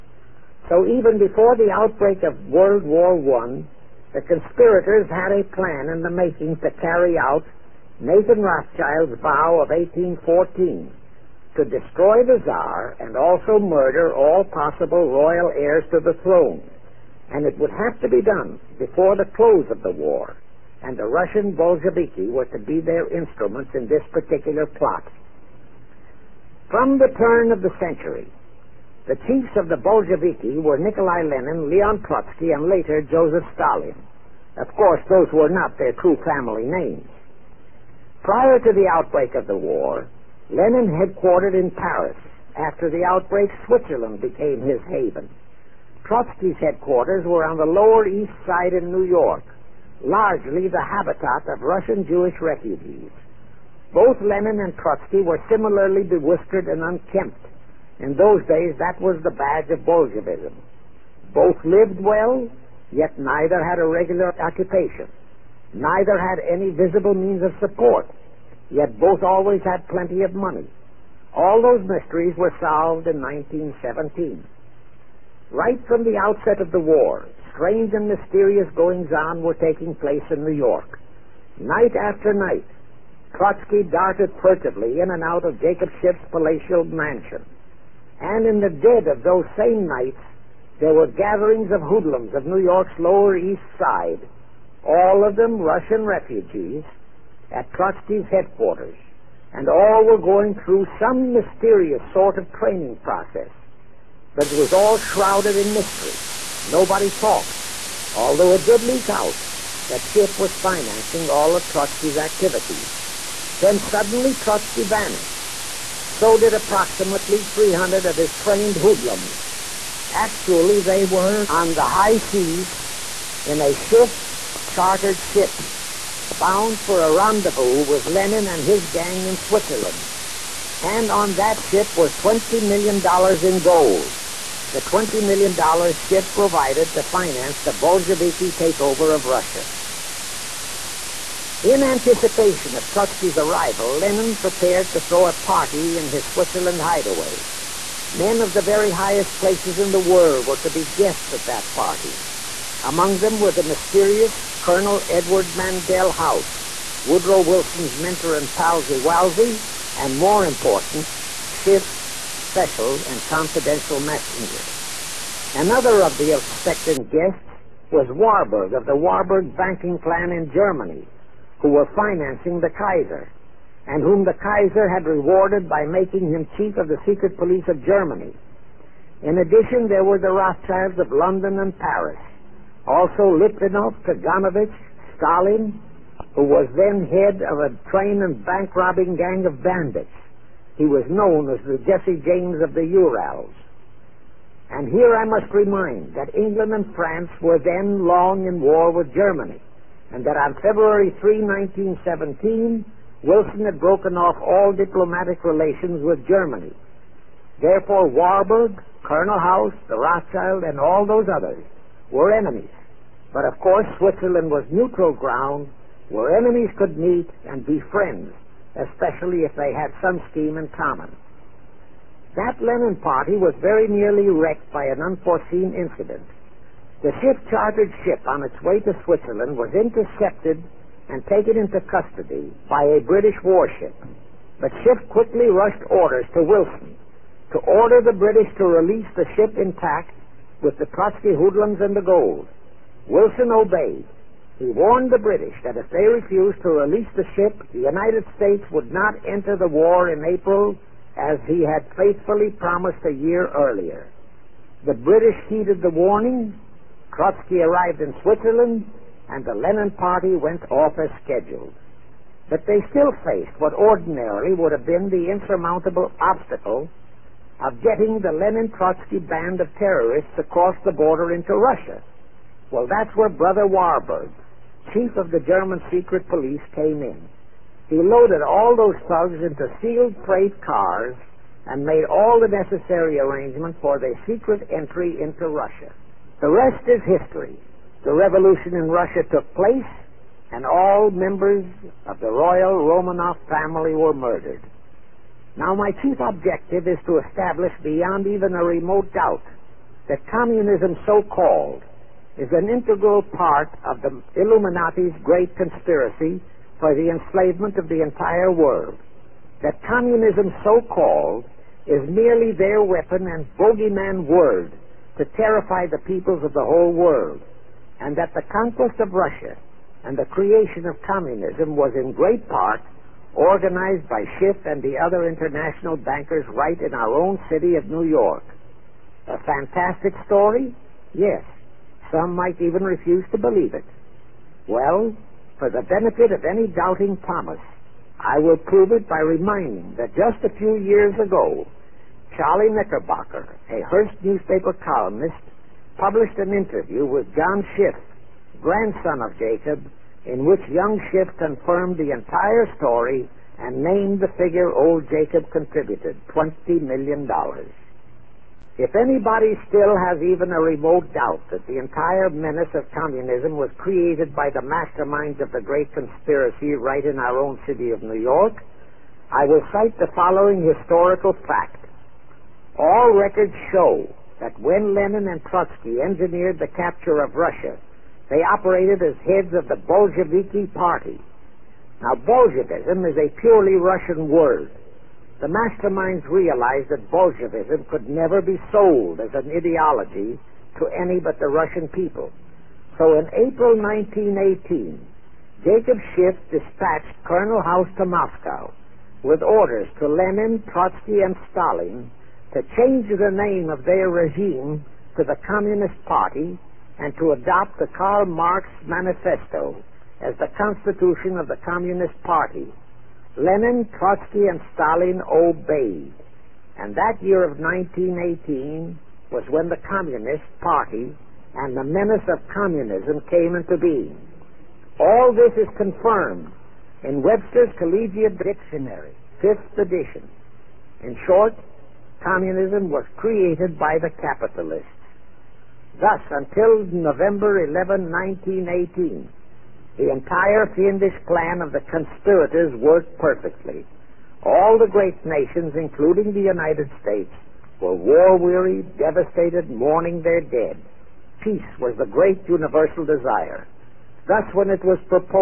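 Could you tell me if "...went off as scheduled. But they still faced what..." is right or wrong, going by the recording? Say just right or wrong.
right.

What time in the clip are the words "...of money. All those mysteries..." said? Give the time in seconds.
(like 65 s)
70 s.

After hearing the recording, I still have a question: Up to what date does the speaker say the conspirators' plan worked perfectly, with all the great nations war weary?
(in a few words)
November 11, 1918.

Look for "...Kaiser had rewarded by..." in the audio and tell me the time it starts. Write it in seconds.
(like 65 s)
174 s.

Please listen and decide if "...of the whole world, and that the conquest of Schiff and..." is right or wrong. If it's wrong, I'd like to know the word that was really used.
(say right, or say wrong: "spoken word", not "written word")
wrong: "Russia", not "Schiff".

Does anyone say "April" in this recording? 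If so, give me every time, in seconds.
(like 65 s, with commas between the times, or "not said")
250 s, 393 s.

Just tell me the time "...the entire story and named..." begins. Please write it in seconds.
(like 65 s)
351 s.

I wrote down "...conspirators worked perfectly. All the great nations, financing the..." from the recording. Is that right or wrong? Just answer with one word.
wrong.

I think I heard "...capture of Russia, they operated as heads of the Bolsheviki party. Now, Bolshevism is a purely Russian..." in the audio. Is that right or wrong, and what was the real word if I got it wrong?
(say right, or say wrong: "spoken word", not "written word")
right.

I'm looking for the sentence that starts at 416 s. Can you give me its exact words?
And that year of 1918 was when the Communist Party and the menace of communism came into being.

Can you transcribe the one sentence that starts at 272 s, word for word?
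Well, that's where Brother Warburg, chief of the German secret police came in.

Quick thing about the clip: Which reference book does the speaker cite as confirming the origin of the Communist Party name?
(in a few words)
Webster's Collegiate Dictionary.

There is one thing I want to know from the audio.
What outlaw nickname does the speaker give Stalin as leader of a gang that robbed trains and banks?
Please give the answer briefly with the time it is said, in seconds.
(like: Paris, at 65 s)
Jesse James of the Urals, at 191 s.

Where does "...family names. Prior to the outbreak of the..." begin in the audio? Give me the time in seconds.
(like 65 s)
36 s.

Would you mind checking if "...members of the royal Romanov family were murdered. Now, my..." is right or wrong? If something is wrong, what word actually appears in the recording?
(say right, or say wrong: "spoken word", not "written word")
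right.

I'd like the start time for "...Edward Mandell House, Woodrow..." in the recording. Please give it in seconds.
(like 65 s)
155 s.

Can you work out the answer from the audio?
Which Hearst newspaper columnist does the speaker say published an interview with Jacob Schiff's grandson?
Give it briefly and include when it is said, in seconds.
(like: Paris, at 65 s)
Charlie Knickerbocker, at 342 s.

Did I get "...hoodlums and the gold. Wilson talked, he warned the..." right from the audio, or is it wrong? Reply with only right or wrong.
wrong.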